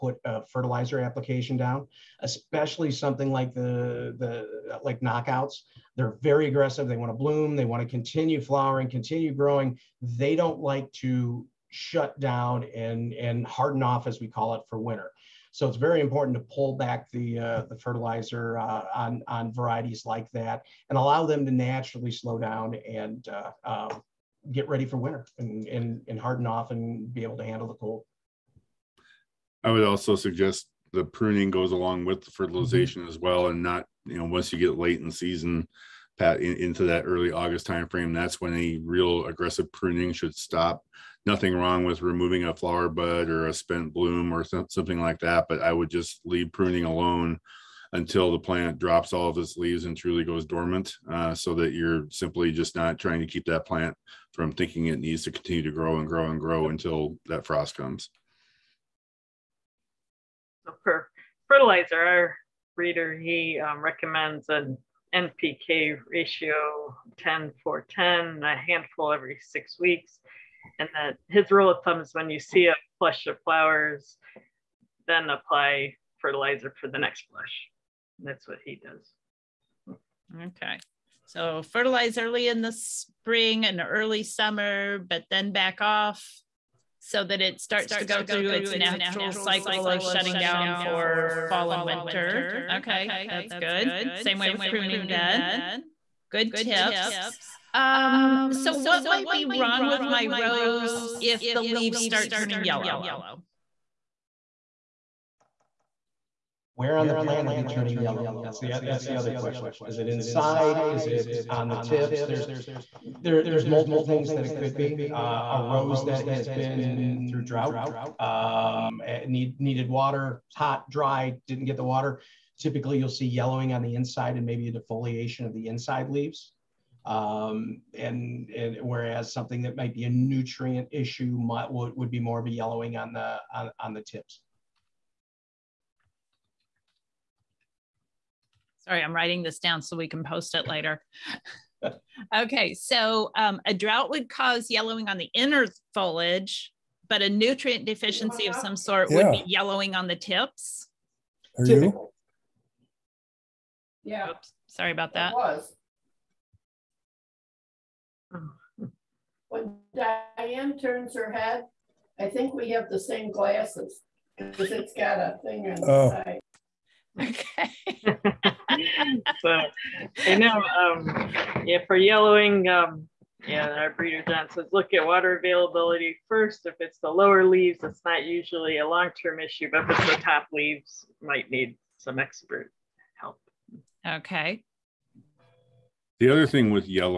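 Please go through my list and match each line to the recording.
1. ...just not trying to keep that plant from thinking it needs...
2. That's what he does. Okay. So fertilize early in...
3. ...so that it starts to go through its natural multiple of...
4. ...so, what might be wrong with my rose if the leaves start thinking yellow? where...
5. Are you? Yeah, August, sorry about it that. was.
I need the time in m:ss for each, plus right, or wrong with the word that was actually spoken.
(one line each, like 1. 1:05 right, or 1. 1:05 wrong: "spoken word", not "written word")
1. 0:52 right
2. 1:18 right
3. 1:26 wrong: "cycle", not "multiple"
4. 1:38 wrong: "turning", not "thinking"
5. 2:31 wrong: "Oops", not "August".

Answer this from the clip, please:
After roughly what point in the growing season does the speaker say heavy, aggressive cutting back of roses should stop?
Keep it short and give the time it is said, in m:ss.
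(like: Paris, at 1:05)
early August, at 0:37.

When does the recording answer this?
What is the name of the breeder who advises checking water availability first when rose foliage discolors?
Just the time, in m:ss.
2:54.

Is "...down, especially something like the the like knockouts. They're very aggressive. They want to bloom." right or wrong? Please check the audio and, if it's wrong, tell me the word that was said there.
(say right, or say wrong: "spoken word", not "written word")
right.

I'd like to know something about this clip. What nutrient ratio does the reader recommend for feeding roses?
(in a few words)
10-10-10.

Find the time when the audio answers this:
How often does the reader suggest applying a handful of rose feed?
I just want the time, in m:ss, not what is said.
1:09.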